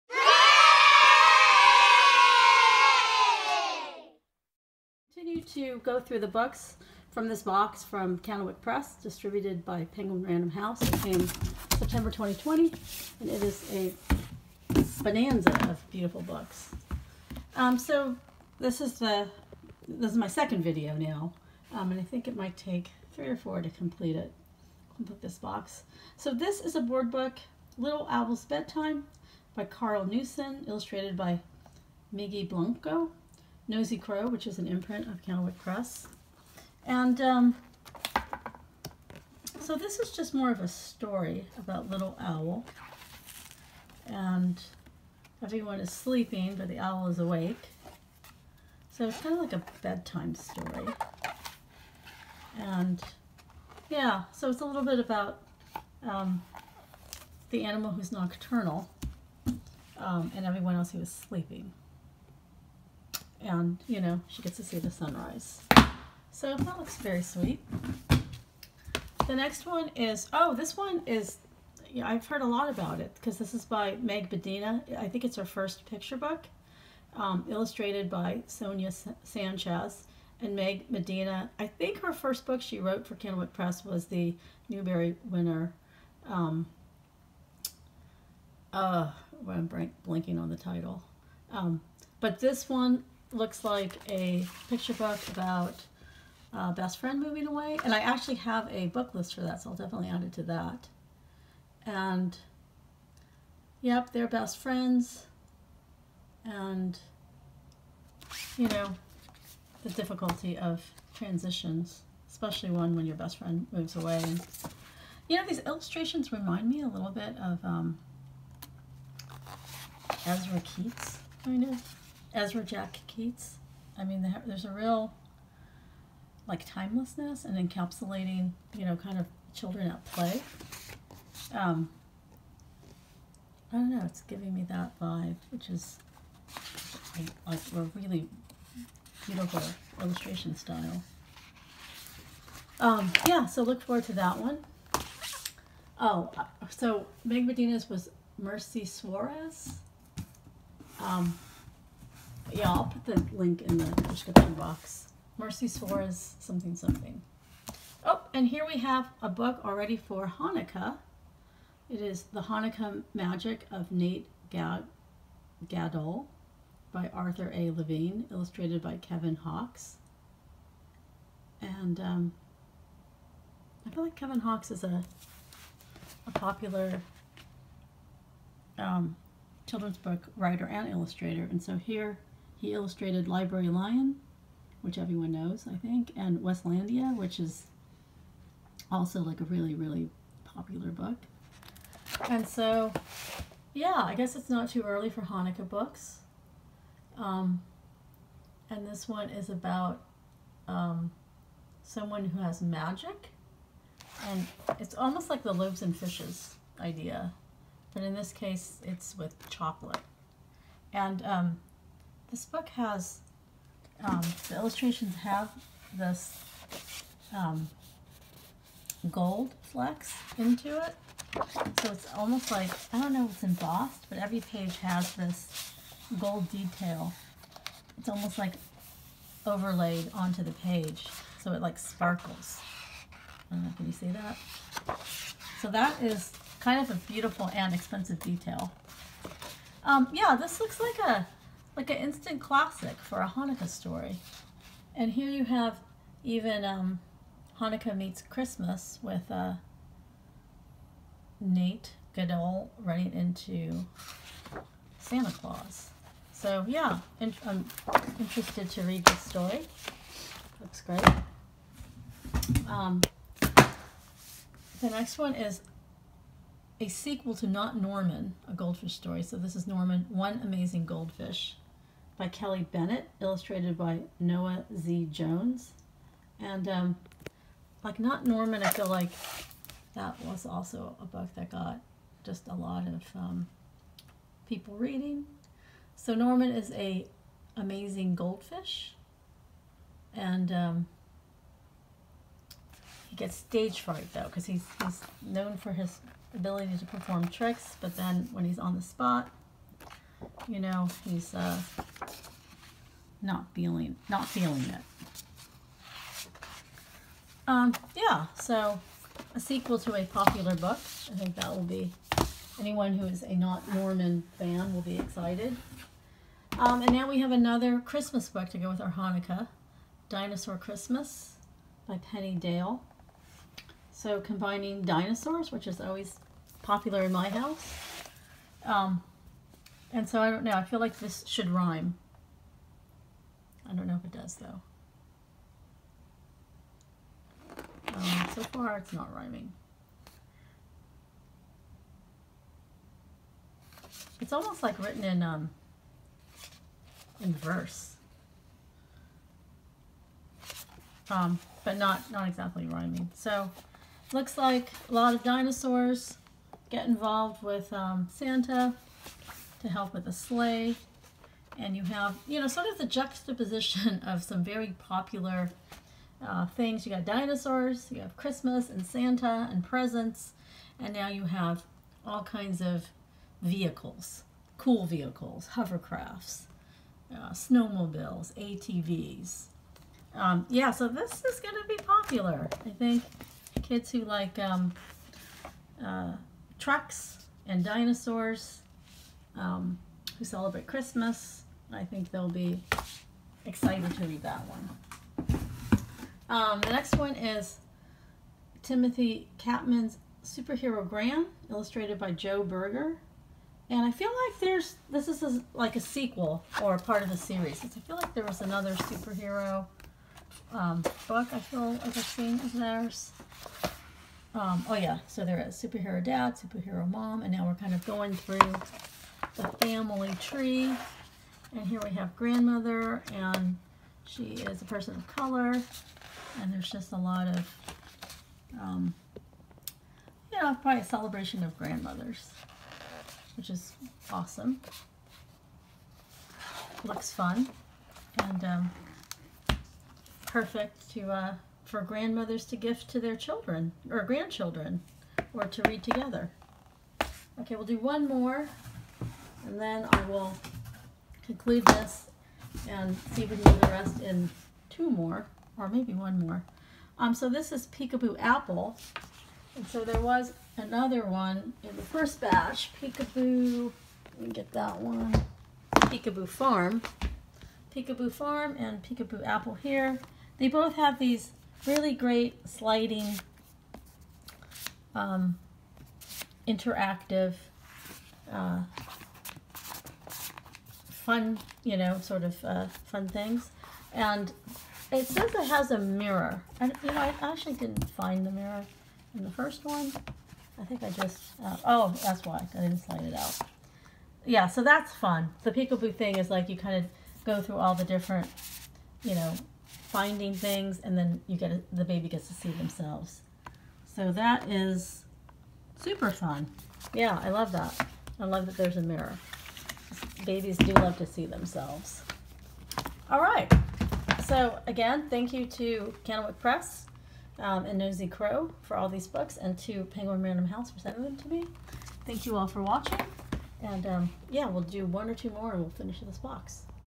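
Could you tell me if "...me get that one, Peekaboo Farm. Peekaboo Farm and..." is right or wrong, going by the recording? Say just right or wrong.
right.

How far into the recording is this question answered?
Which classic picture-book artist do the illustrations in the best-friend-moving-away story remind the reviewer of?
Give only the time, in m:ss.
2:02.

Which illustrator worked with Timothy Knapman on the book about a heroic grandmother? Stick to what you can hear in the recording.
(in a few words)
Joe Berger.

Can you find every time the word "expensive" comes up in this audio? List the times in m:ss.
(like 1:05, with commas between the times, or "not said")
3:57.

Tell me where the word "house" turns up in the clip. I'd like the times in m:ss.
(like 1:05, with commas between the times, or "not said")
0:10, 5:27, 8:40.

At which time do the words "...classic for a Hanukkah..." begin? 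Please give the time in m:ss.
4:02.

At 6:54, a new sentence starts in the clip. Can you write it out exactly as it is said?
Um, oh yeah, so there is Superhero Dad, Superhero Mom, and now we're kind of going through the family tree.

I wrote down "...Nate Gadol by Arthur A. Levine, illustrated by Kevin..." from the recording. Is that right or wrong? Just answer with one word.
right.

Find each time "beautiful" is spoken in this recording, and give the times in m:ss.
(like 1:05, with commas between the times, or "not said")
0:15, 2:19, 3:57.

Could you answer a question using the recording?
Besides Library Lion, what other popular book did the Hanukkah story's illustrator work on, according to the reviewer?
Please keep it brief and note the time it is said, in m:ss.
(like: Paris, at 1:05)
Weslandia, at 3:06.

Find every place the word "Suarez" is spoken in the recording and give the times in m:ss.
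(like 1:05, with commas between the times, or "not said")
2:28, 2:35.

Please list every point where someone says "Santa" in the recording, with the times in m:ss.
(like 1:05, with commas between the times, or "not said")
4:14, 5:58, 6:08.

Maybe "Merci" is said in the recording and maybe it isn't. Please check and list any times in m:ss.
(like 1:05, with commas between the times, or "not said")
2:28, 2:35.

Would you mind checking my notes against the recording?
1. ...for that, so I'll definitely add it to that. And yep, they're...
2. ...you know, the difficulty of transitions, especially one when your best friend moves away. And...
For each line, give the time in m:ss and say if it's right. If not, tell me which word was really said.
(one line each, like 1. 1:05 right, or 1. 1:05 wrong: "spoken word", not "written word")
1. 1:39 right
2. 1:48 right.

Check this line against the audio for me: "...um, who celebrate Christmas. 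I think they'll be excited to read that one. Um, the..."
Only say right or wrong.
right.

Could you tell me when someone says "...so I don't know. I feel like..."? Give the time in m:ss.
5:30.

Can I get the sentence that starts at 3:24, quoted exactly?
And it's almost like the loaves and fishes idea.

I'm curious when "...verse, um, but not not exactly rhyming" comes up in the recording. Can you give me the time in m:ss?
5:47.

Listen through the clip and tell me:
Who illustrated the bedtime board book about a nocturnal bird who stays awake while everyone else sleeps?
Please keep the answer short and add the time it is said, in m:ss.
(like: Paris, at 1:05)
Miggy Blanco, at 0:32.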